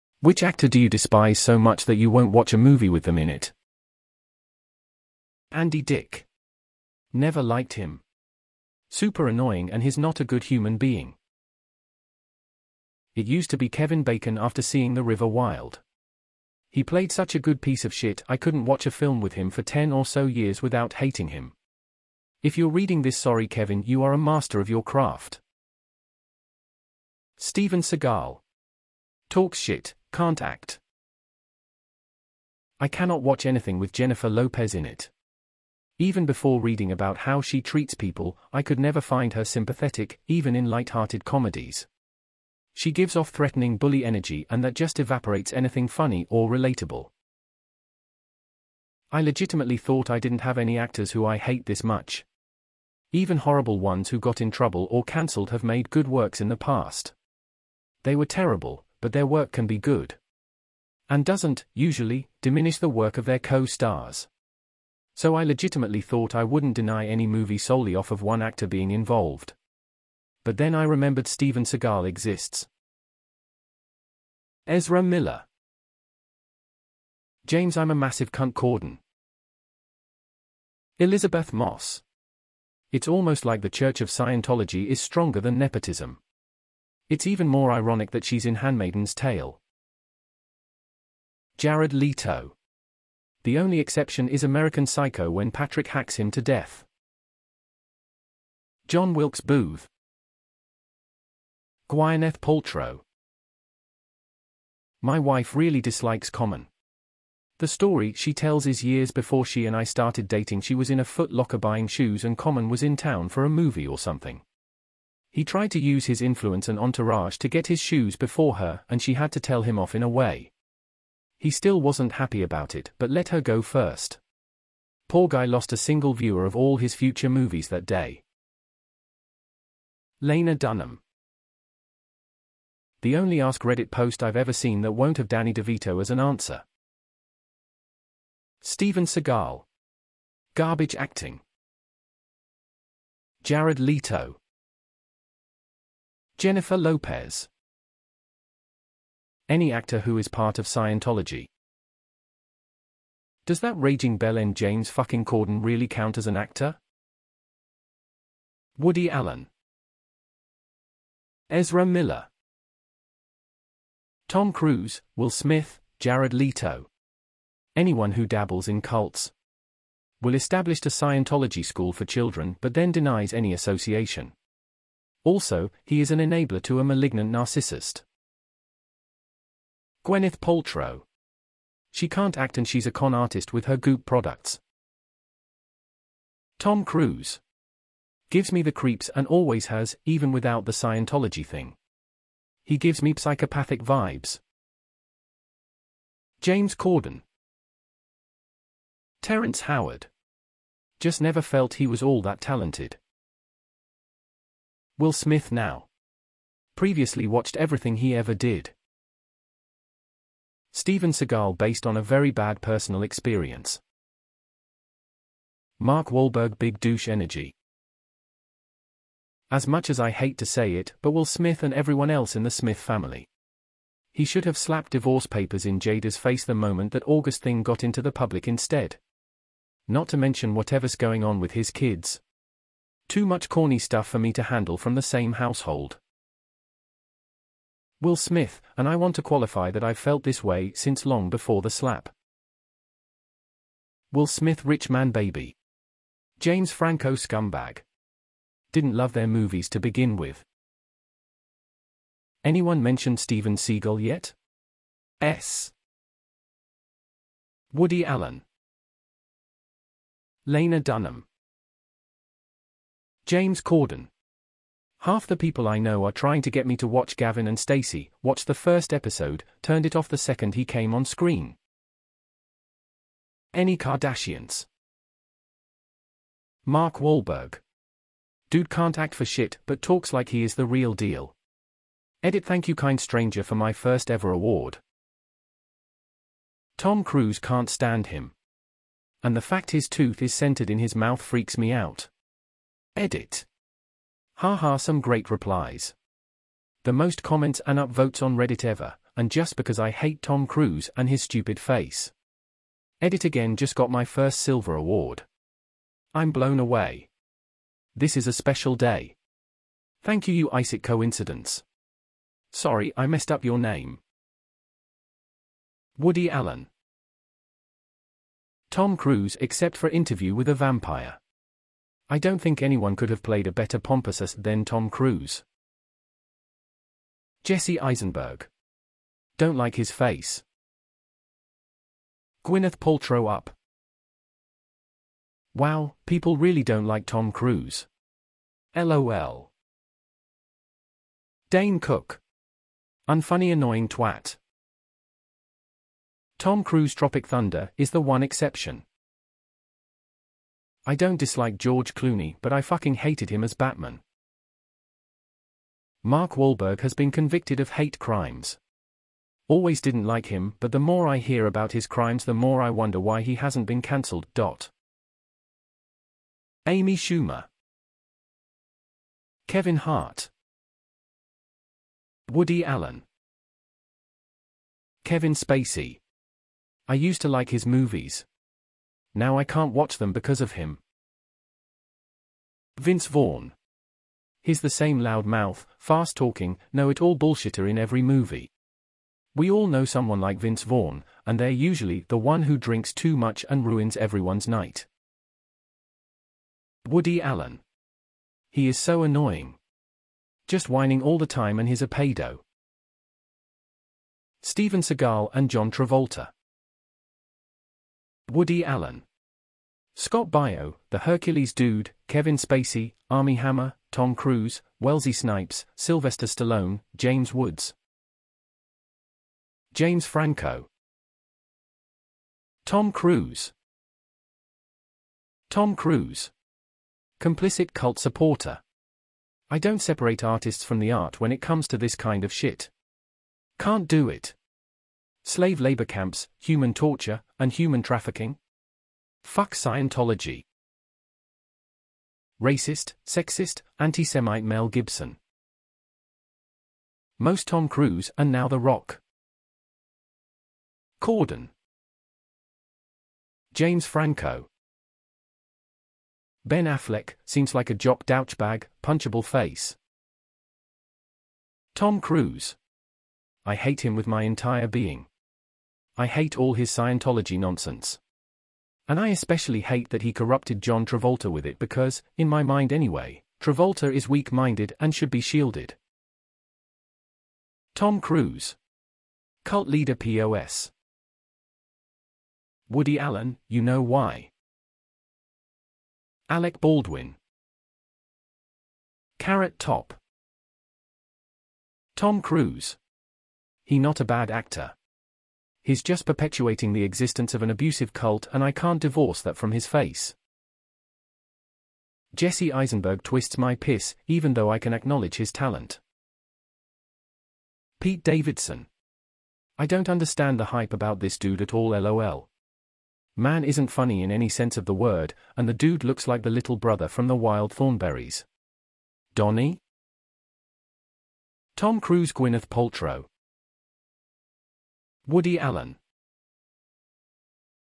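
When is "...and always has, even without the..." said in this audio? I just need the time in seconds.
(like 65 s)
189 s.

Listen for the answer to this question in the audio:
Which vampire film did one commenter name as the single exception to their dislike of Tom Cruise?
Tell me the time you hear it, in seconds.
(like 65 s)
319 s.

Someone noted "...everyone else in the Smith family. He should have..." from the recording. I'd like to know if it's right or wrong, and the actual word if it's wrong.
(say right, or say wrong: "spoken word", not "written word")
right.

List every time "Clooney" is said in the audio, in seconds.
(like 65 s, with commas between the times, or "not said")
351 s.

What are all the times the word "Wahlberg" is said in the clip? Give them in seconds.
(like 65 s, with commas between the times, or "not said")
216 s, 276 s, 356 s.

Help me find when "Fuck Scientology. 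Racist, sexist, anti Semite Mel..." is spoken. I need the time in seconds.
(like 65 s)
439 s.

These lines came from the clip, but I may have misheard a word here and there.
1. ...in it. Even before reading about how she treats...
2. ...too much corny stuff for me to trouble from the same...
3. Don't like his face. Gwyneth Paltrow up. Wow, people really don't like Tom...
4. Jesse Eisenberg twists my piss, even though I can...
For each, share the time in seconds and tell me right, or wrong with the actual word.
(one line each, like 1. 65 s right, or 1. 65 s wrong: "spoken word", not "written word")
1. 34 s right
2. 233 s wrong: "handle", not "trouble"
3. 329 s right
4. 502 s right.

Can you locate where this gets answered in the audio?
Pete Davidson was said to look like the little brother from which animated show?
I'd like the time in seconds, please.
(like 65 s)
517 s.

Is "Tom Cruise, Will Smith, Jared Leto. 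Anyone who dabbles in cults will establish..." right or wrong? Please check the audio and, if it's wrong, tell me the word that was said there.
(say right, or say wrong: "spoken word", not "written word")
right.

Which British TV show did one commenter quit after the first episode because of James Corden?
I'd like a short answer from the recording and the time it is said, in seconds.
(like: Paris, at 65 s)
Gavin and Stacey, at 267 s.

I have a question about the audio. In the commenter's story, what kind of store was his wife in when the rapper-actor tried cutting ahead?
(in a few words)
Foot Locker.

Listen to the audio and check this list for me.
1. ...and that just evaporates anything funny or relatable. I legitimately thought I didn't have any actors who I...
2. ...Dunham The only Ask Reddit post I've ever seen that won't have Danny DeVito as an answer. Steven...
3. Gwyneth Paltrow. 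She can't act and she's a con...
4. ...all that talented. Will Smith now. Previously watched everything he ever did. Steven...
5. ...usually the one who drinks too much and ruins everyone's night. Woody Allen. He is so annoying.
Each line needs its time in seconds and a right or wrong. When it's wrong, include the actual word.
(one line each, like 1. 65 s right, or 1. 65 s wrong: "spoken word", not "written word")
1. 44 s right
2. 130 s right
3. 180 s right
4. 202 s right
5. 391 s right.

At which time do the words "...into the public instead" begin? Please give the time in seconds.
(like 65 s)
227 s.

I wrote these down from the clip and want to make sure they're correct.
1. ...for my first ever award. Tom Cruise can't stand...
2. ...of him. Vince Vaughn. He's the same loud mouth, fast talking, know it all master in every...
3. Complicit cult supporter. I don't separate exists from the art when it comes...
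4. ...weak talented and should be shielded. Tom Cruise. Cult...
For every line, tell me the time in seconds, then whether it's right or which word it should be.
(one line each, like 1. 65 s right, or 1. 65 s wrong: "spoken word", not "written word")
1. 283 s right
2. 380 s wrong: "bullshitter", not "master"
3. 427 s wrong: "artists", not "exists"
4. 474 s wrong: "minded", not "talented".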